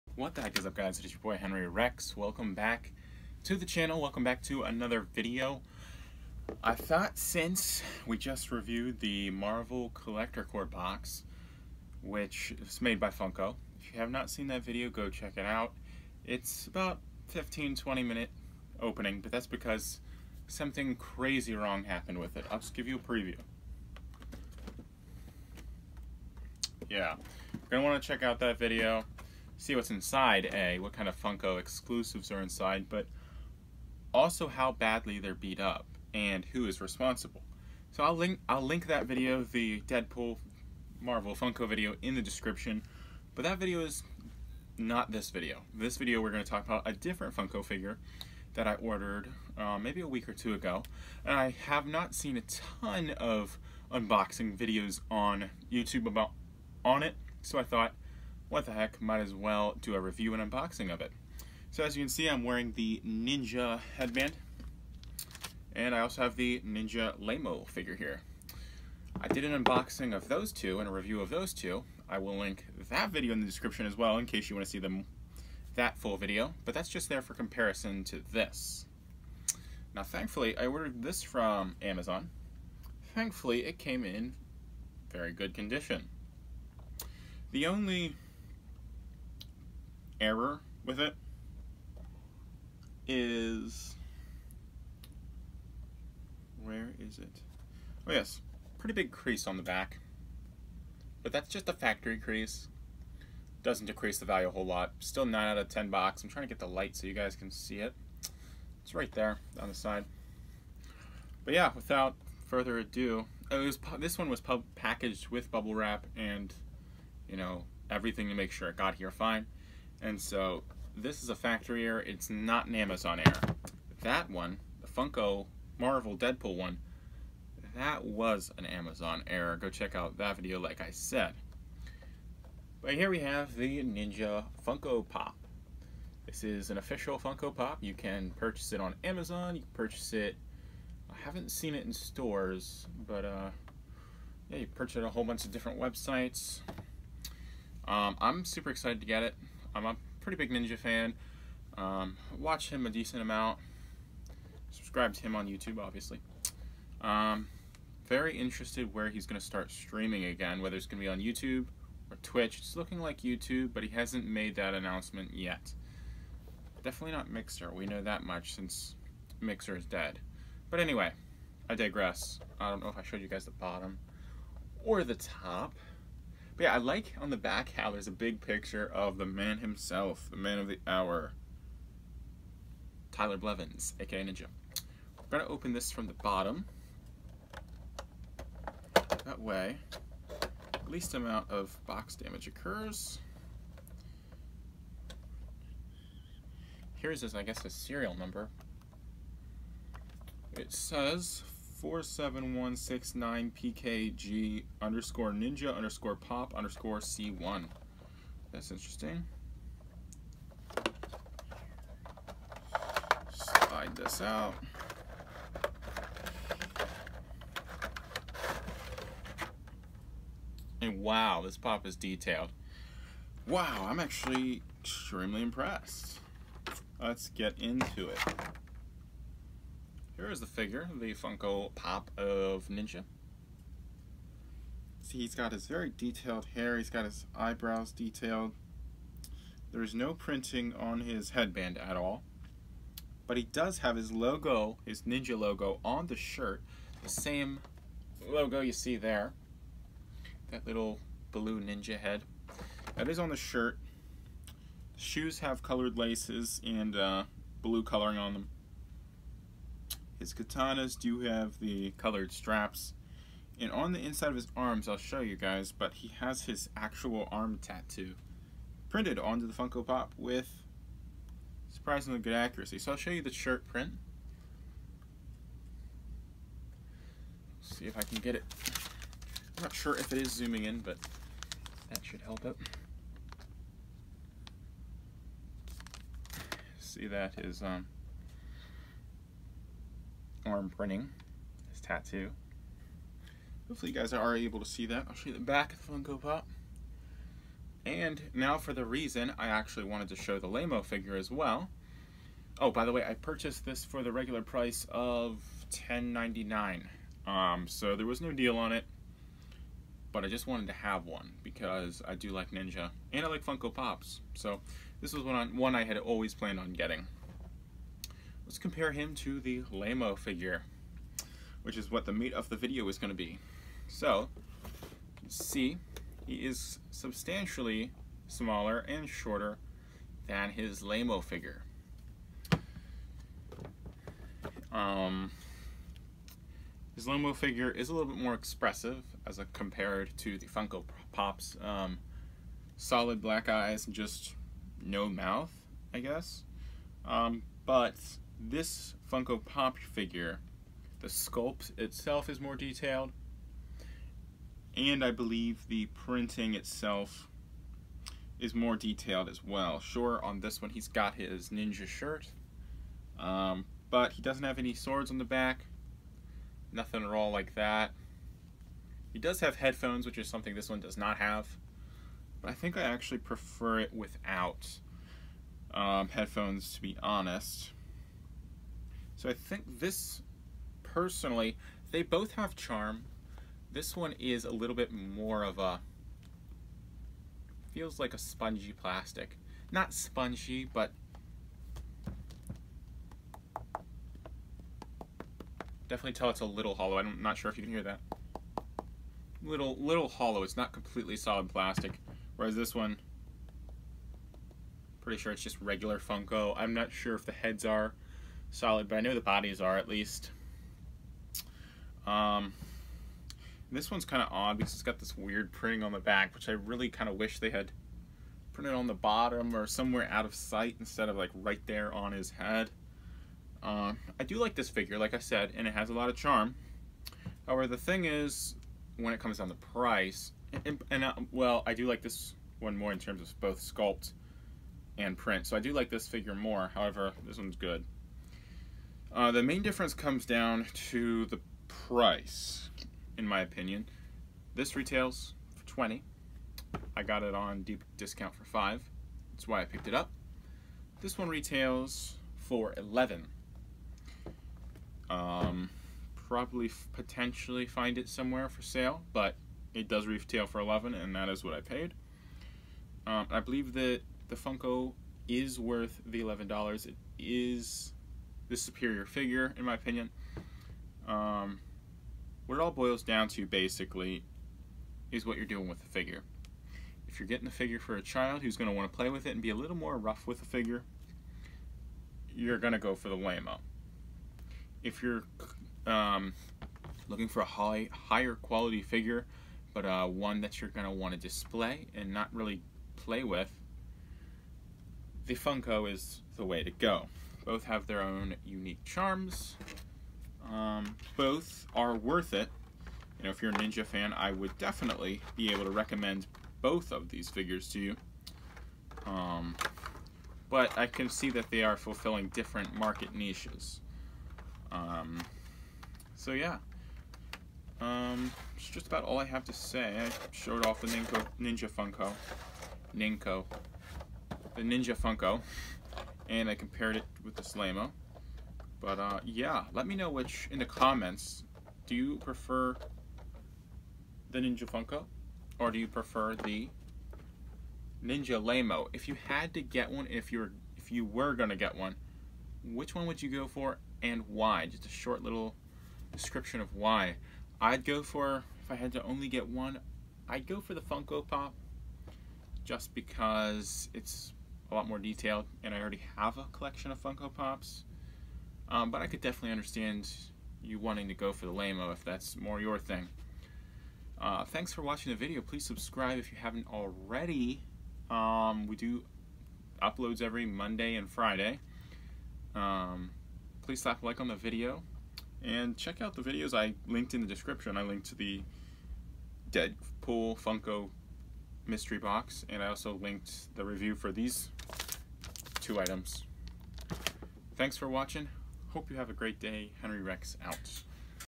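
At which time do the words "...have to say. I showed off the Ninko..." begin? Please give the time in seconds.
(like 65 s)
519 s.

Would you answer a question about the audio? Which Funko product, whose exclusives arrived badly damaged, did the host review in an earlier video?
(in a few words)
Marvel Collector Corps box.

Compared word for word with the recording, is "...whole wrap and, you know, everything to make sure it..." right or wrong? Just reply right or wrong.
wrong.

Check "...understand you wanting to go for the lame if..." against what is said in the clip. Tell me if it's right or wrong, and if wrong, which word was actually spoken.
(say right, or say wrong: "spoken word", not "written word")
right.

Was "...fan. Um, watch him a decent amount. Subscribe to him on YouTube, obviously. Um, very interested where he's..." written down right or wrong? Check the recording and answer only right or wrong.
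right.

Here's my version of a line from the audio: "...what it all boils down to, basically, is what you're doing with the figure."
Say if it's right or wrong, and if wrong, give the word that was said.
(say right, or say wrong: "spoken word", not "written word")
right.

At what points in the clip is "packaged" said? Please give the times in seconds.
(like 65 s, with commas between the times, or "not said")
114 s.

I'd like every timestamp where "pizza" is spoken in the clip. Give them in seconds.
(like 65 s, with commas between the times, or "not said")
not said.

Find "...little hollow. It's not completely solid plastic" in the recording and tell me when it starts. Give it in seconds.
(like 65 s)
399 s.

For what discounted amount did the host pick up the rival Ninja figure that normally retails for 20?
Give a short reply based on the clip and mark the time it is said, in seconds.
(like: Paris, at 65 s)
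$5, at 448 s.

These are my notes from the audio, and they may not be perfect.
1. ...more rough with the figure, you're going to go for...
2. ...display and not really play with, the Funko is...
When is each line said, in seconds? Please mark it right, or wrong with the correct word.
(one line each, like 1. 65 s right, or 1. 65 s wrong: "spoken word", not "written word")
1. 479 s right
2. 491 s right.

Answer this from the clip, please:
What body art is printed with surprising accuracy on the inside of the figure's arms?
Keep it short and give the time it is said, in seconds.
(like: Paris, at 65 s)
Arm tattoo, at 267 s.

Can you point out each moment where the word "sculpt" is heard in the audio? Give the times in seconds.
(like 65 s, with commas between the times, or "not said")
351 s, 433 s.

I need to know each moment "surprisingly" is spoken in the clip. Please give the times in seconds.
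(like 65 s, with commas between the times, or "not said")
271 s.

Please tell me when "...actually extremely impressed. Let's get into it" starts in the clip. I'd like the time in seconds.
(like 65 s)
223 s.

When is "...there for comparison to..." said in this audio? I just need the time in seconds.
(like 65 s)
77 s.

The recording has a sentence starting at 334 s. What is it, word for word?
Um, his Lamo figure is a little bit more expressive as a, compared to the Funko Pops.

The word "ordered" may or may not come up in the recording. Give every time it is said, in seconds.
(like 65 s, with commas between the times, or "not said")
48 s, 80 s.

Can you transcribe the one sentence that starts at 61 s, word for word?
So as you can see, I'm wearing the Ninja headband, and I also have the Ninja Lamo figure here.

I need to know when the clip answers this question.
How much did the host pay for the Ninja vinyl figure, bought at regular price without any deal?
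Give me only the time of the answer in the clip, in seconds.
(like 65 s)
305 s.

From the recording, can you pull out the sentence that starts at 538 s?
If you had to get one, if you're if you were gonna get one, which one would you go for and why?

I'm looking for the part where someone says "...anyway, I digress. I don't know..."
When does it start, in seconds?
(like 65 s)
170 s.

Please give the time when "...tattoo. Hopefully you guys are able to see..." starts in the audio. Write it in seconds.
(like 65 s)
291 s.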